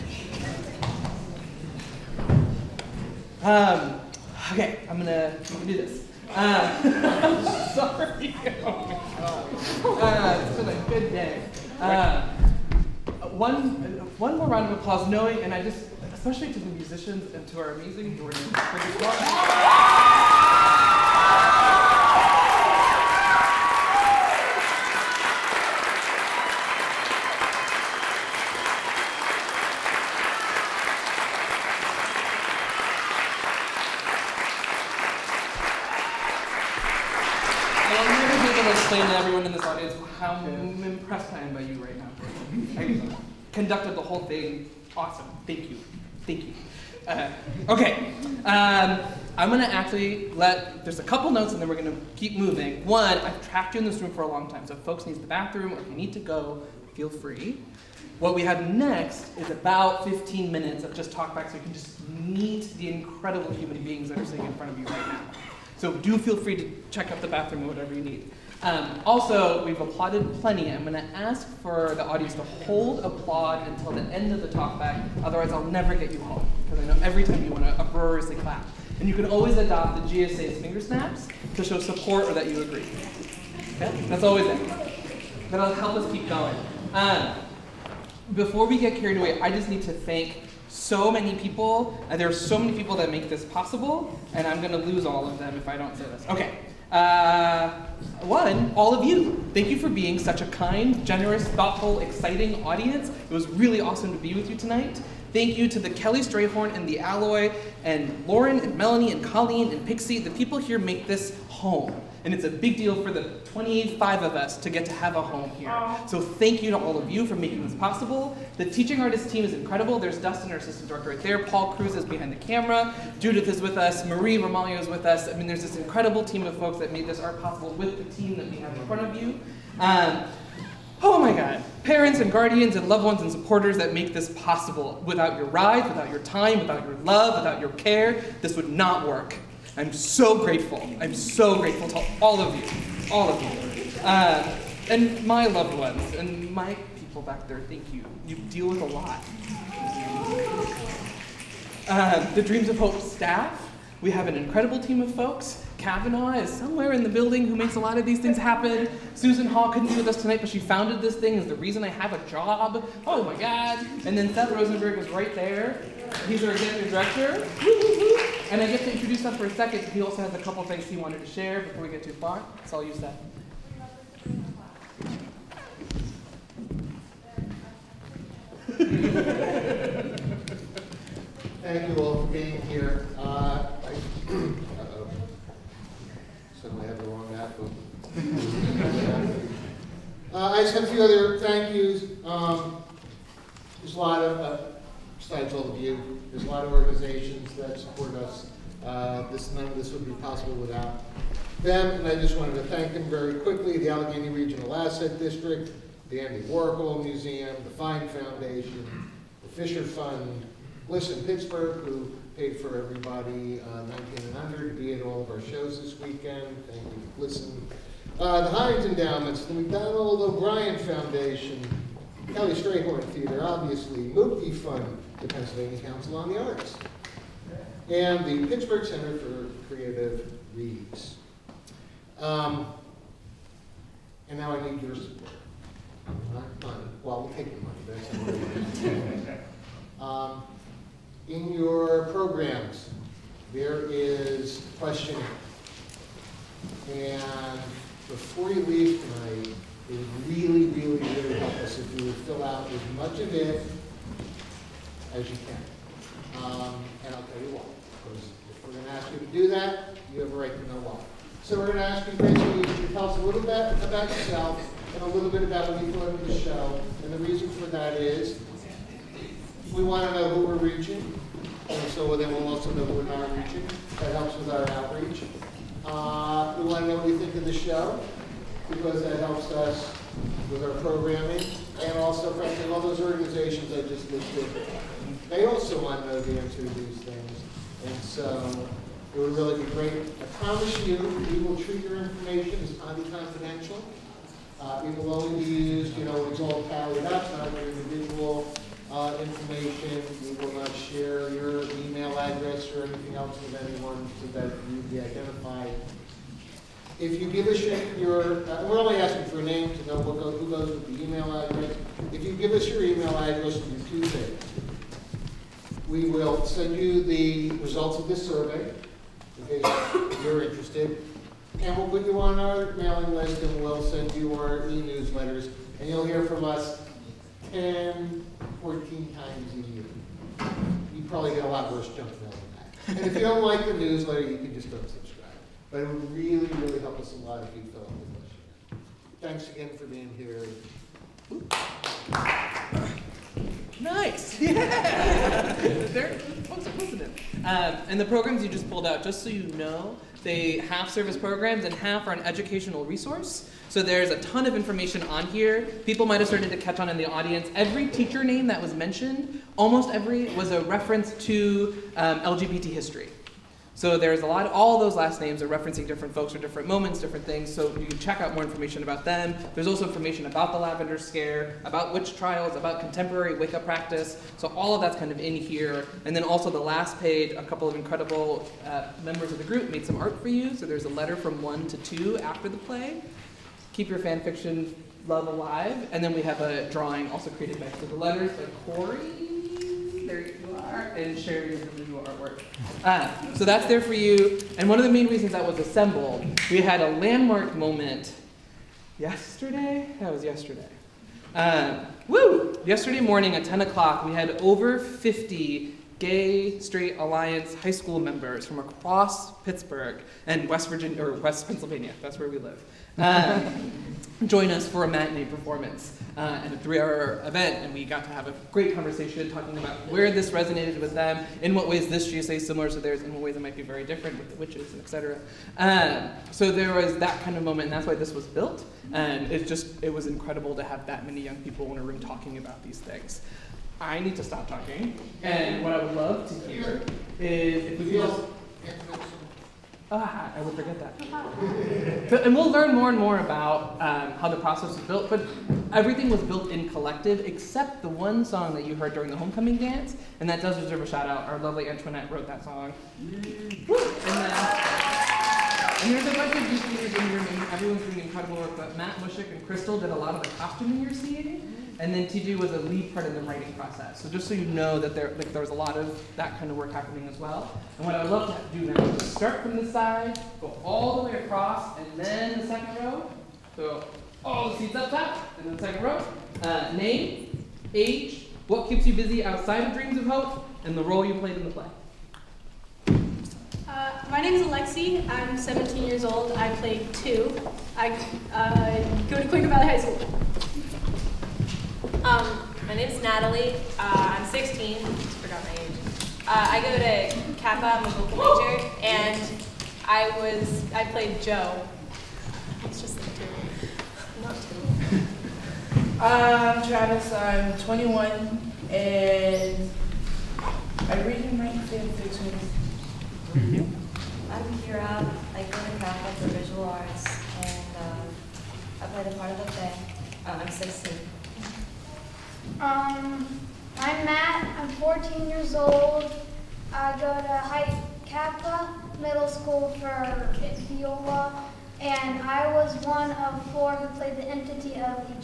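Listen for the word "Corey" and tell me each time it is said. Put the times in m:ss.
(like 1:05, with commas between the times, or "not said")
6:28.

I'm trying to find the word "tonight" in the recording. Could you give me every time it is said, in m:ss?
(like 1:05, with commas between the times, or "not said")
1:44, 2:40, 4:09.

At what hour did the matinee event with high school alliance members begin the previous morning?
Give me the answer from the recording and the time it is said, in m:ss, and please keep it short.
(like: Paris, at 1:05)
10 o'clock, at 6:43.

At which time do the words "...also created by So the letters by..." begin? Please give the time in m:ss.
6:27.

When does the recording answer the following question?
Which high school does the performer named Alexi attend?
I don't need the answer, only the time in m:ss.
8:09.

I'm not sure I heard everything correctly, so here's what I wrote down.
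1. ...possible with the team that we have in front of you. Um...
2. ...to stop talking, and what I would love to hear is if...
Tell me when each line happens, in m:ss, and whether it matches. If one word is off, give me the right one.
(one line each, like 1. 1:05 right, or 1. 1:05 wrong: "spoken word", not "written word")
1. 2:07 right
2. 7:14 right.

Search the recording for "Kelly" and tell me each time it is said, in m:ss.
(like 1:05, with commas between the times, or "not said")
1:45, 3:42.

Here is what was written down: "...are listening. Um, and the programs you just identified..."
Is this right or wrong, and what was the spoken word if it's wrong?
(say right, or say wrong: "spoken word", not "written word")
wrong: "pulled", not "identified".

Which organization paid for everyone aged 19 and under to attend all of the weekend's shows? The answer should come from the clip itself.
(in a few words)
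Listen Pittsburgh.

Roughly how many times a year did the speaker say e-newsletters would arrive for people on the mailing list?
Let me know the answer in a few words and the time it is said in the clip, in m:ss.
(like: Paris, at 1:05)
10 to 14, at 5:27.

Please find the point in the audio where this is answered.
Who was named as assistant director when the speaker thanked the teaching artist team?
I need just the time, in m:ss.
2:00.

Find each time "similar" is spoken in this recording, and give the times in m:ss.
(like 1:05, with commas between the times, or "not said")
7:02.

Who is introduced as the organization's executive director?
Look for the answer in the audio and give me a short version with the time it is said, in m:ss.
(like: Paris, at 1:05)
Seth Rosenberg, at 2:44.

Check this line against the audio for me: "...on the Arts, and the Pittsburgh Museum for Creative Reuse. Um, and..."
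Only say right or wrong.
wrong.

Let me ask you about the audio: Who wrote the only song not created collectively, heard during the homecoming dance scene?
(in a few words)
Antoinette.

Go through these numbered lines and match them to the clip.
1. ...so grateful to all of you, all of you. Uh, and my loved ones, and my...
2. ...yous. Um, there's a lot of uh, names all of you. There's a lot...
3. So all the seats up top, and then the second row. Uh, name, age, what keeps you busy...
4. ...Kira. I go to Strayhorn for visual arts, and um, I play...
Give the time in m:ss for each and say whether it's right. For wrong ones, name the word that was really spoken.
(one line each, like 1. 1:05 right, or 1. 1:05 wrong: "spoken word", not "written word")
1. 2:21 right
2. 3:11 wrong: "besides", not "names"
3. 7:53 right
4. 8:34 wrong: "CAPA", not "Strayhorn".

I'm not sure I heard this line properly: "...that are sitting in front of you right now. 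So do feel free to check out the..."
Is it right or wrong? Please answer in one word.
right.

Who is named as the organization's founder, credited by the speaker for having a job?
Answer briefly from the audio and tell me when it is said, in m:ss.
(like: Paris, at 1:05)
Susan Hall, at 2:39.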